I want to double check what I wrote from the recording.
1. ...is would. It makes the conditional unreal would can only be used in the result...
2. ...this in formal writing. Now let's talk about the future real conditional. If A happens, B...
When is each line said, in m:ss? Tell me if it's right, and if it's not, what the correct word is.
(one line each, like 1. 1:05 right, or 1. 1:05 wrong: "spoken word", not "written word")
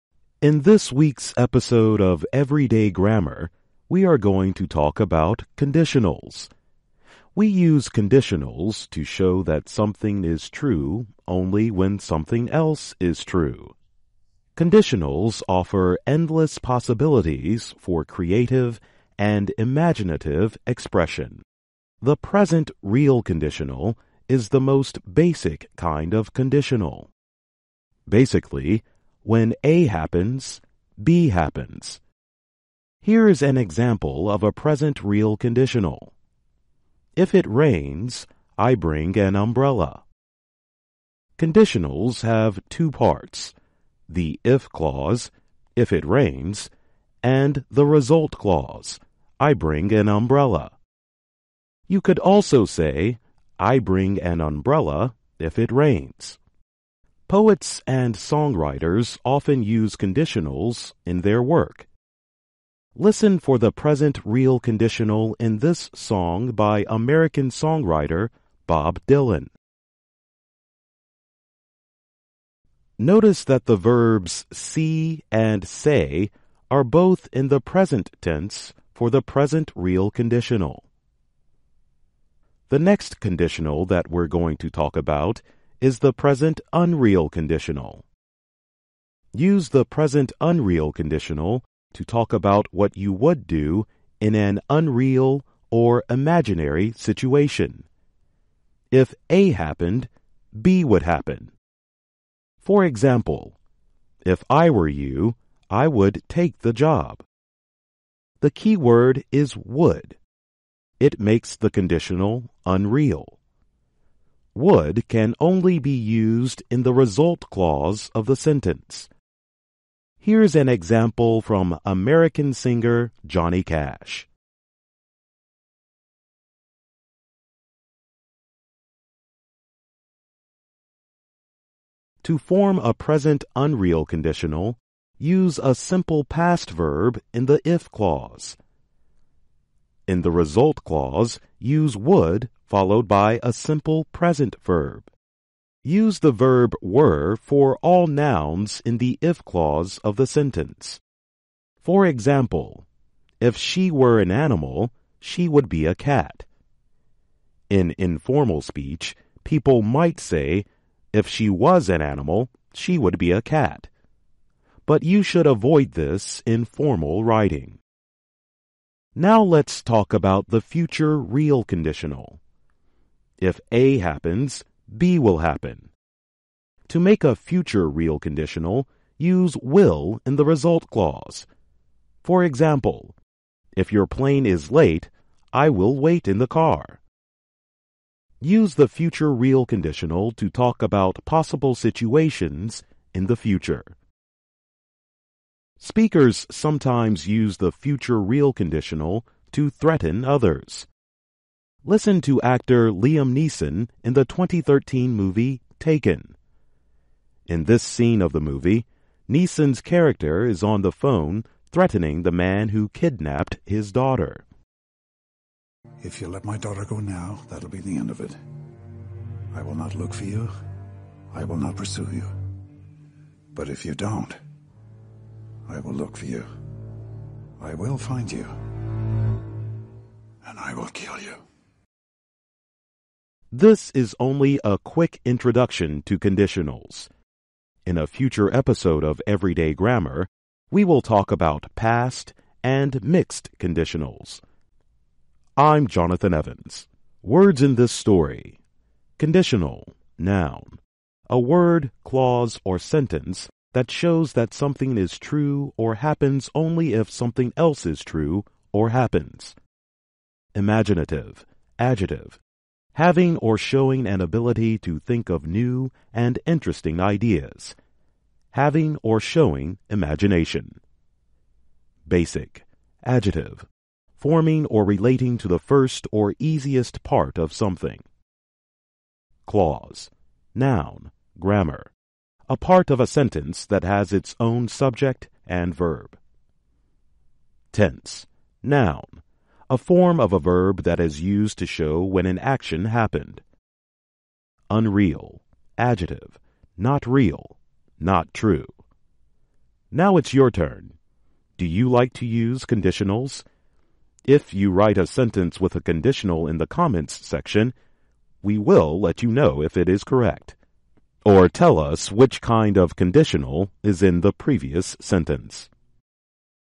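1. 1:49 right
2. 2:45 right.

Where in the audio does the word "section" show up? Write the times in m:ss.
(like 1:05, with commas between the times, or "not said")
5:07.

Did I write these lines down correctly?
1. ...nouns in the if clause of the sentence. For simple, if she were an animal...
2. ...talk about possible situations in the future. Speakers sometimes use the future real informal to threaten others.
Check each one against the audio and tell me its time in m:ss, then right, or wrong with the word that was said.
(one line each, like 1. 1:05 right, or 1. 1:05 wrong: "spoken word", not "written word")
1. 2:28 wrong: "example", not "simple"
2. 3:10 wrong: "conditional", not "informal".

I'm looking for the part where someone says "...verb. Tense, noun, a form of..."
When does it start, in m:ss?
4:45.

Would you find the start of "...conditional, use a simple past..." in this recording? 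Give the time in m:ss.
2:14.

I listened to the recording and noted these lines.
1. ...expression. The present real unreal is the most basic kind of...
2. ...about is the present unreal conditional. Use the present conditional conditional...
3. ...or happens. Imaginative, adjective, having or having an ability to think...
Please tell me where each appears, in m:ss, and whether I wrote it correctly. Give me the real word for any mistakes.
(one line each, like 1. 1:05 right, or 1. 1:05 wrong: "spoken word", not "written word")
1. 0:20 wrong: "conditional", not "unreal"
2. 1:24 wrong: "unreal", not "conditional"
3. 4:18 wrong: "showing", not "having".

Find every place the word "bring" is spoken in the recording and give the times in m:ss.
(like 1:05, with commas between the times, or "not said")
0:38, 0:49, 0:53.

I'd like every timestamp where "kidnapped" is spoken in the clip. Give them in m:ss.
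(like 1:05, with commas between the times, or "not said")
3:32.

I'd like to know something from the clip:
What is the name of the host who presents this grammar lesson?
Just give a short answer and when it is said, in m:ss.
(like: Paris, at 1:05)
Jonathan Evans, at 4:05.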